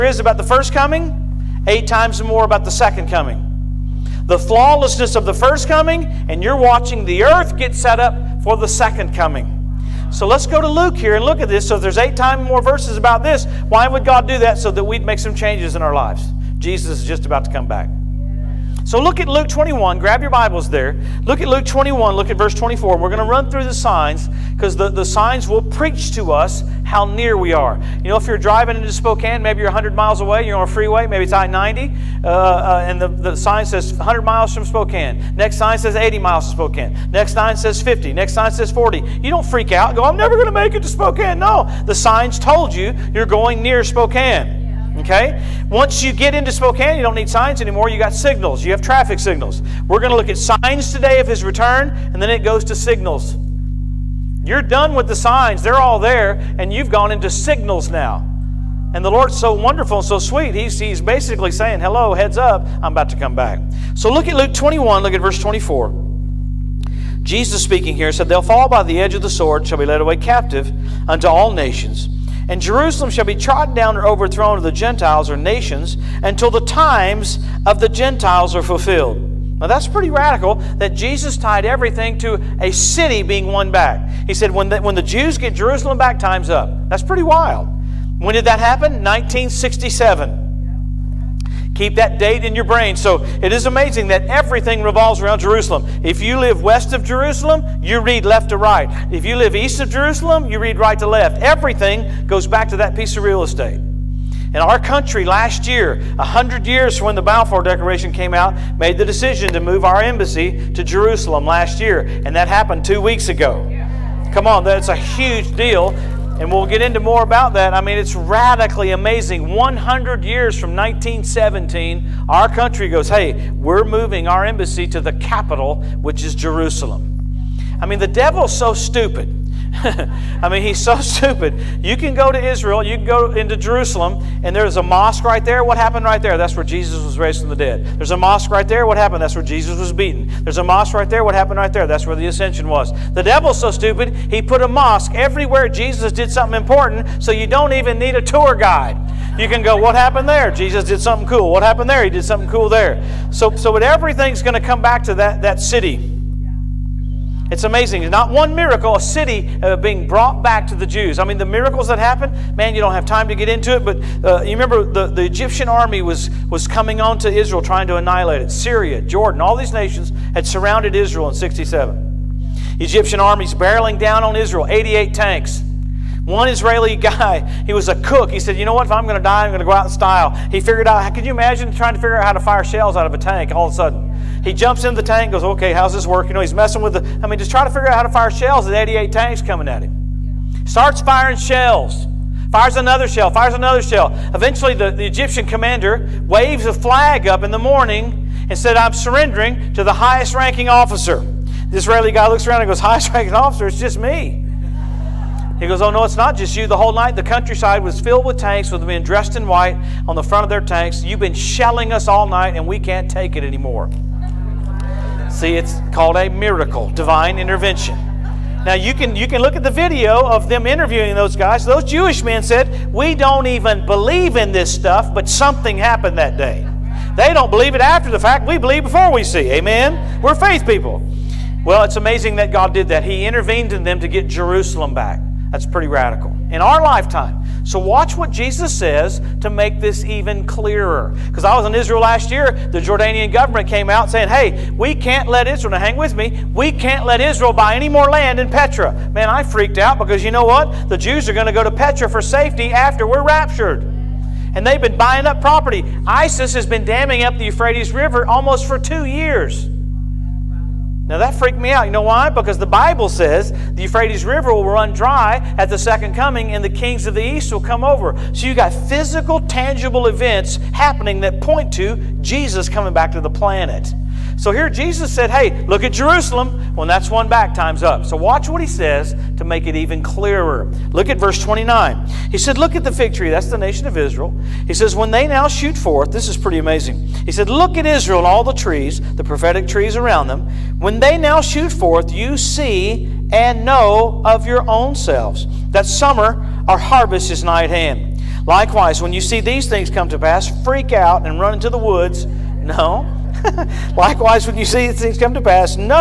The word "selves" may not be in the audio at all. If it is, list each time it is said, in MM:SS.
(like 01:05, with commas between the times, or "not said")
04:54.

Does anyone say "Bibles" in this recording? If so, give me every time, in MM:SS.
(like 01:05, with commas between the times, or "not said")
00:20, 04:22.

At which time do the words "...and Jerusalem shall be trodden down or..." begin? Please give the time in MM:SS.
01:12.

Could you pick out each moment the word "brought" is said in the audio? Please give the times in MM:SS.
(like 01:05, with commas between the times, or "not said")
02:40.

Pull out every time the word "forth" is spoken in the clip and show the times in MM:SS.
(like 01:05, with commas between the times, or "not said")
04:45, 04:51.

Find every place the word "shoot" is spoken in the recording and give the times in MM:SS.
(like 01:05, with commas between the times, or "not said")
04:45, 04:51.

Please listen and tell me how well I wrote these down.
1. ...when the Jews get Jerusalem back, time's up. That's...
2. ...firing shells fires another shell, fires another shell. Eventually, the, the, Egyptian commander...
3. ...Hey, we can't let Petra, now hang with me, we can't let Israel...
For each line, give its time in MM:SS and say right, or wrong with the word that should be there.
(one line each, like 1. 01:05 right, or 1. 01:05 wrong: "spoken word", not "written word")
1. 01:24 right
2. 03:11 right
3. 04:04 wrong: "Israel", not "Petra".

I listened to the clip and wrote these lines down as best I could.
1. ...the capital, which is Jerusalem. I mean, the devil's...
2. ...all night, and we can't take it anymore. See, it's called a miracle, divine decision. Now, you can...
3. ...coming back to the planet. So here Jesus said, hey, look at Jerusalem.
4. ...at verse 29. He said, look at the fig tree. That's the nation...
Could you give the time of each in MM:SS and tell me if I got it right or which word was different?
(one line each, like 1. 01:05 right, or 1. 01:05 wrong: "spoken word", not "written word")
1. 02:05 right
2. 03:32 wrong: "intervention", not "decision"
3. 04:32 right
4. 04:41 right.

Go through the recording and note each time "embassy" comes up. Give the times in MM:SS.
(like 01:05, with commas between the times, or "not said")
01:50, 02:04.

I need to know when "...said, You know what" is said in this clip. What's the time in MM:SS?
02:58.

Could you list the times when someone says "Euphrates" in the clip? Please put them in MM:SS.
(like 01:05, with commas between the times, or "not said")
04:17, 04:23.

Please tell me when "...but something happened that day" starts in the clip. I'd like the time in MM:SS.
03:45.